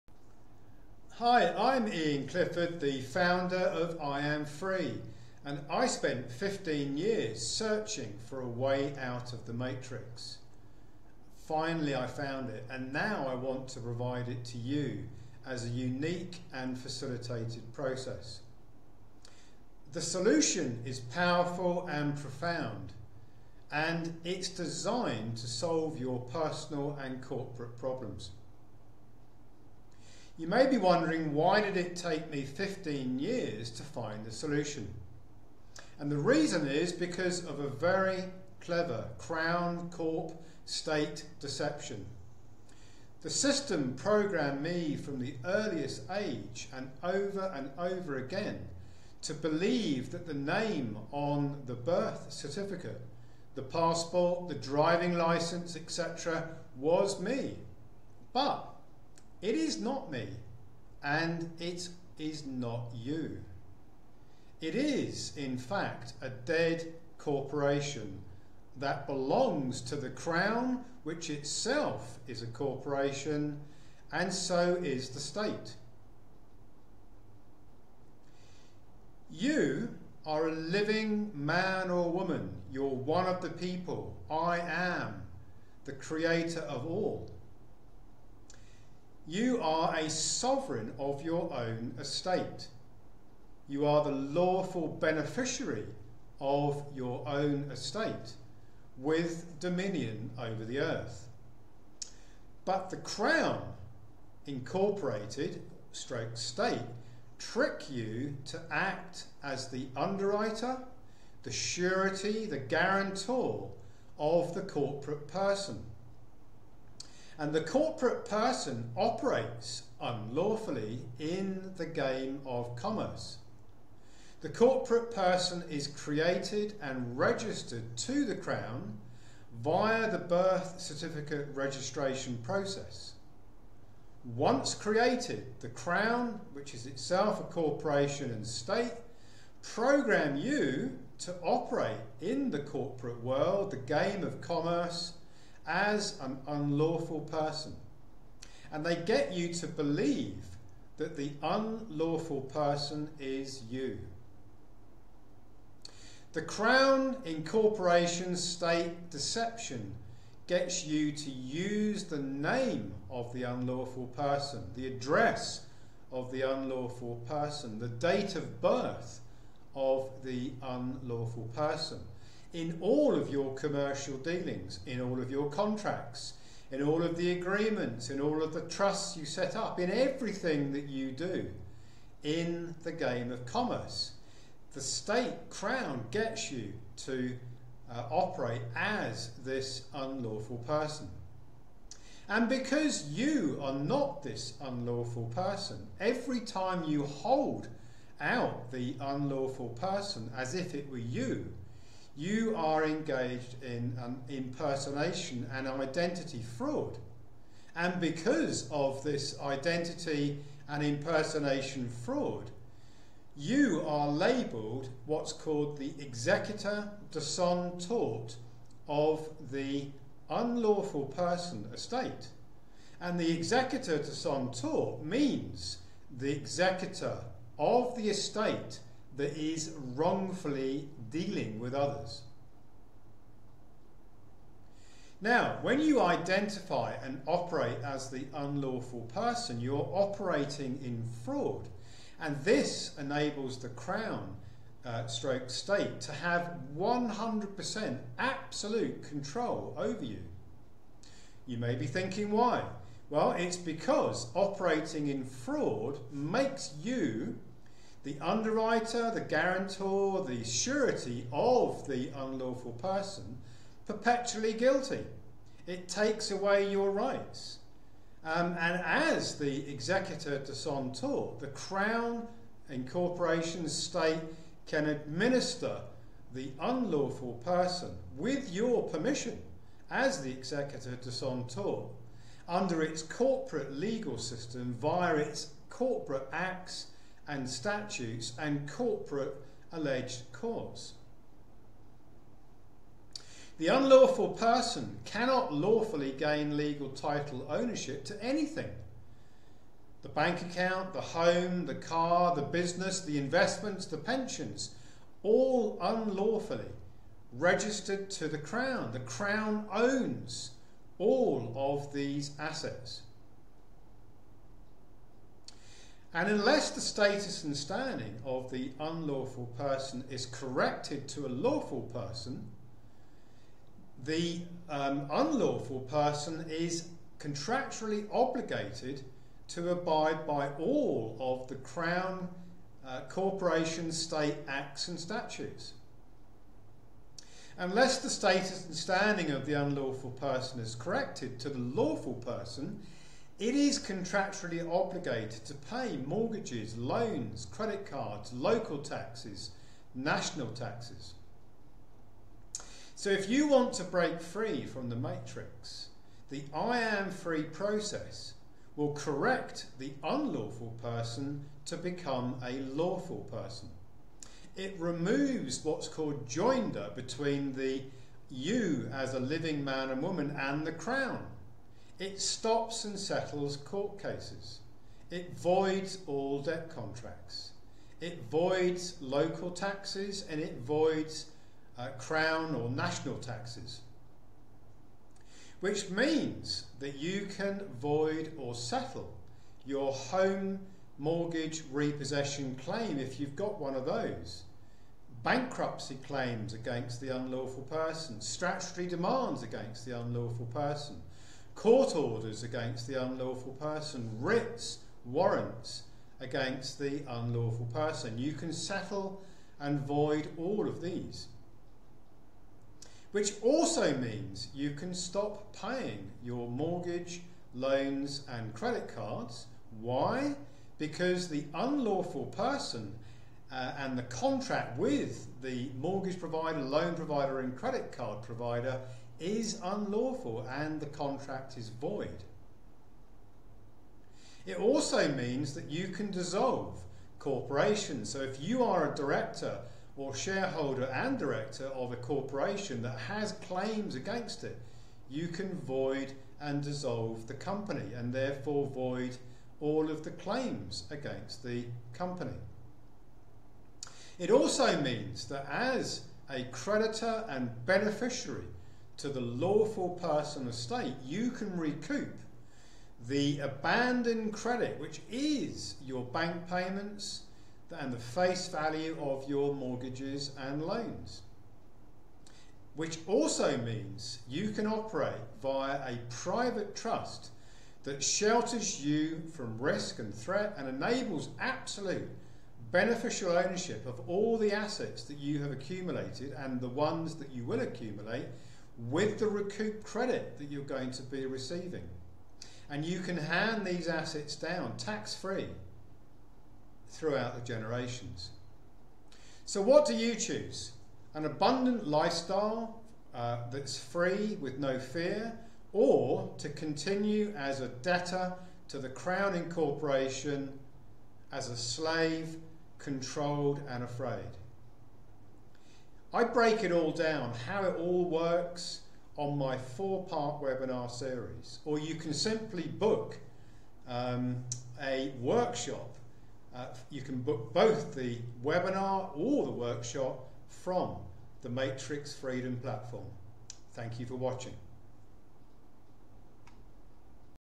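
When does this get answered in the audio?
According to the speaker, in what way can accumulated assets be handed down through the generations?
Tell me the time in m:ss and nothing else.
8:14.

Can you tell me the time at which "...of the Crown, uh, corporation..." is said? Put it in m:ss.
5:31.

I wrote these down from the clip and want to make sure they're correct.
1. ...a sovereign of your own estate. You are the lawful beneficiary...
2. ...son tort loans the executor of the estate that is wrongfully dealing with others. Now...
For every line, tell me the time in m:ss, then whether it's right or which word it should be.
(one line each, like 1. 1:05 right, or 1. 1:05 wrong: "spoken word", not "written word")
1. 1:29 right
2. 3:44 wrong: "means", not "loans".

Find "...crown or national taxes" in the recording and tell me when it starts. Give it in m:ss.
6:21.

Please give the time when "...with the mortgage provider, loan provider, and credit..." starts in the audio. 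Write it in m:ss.
7:04.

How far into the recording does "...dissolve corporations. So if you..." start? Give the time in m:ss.
7:16.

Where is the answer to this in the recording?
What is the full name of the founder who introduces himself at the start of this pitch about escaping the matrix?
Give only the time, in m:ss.
0:01.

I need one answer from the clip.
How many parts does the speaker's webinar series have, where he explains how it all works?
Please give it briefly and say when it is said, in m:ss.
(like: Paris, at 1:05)
4, at 8:39.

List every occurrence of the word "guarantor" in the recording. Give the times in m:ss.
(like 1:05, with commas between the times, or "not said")
1:52, 4:19.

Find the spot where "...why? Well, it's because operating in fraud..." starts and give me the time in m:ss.
4:12.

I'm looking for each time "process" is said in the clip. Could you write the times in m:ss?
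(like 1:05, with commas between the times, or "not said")
0:17, 2:12, 5:57.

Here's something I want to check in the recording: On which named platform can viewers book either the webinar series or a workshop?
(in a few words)
Matrix Freedom.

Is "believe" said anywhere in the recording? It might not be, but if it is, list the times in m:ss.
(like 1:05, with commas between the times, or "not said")
0:49, 2:29.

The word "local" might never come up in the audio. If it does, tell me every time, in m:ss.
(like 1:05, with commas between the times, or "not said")
5:48, 6:18.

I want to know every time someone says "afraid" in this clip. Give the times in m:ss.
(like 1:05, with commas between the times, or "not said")
8:33.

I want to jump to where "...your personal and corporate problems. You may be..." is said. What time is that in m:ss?
0:25.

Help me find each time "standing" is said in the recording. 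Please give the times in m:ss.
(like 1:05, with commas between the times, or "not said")
5:17, 5:38.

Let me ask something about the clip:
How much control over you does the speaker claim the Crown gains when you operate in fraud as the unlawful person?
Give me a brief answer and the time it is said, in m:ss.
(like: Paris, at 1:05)
100% absolute control, at 4:06.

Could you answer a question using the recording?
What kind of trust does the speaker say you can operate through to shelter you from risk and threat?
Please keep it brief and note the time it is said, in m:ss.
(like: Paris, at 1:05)
private trust, at 7:56.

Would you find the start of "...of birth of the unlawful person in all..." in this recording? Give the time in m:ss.
2:48.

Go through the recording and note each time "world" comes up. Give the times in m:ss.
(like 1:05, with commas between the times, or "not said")
2:23.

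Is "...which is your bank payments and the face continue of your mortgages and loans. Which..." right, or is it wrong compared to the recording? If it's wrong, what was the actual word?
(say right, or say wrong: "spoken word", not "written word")
wrong: "value", not "continue".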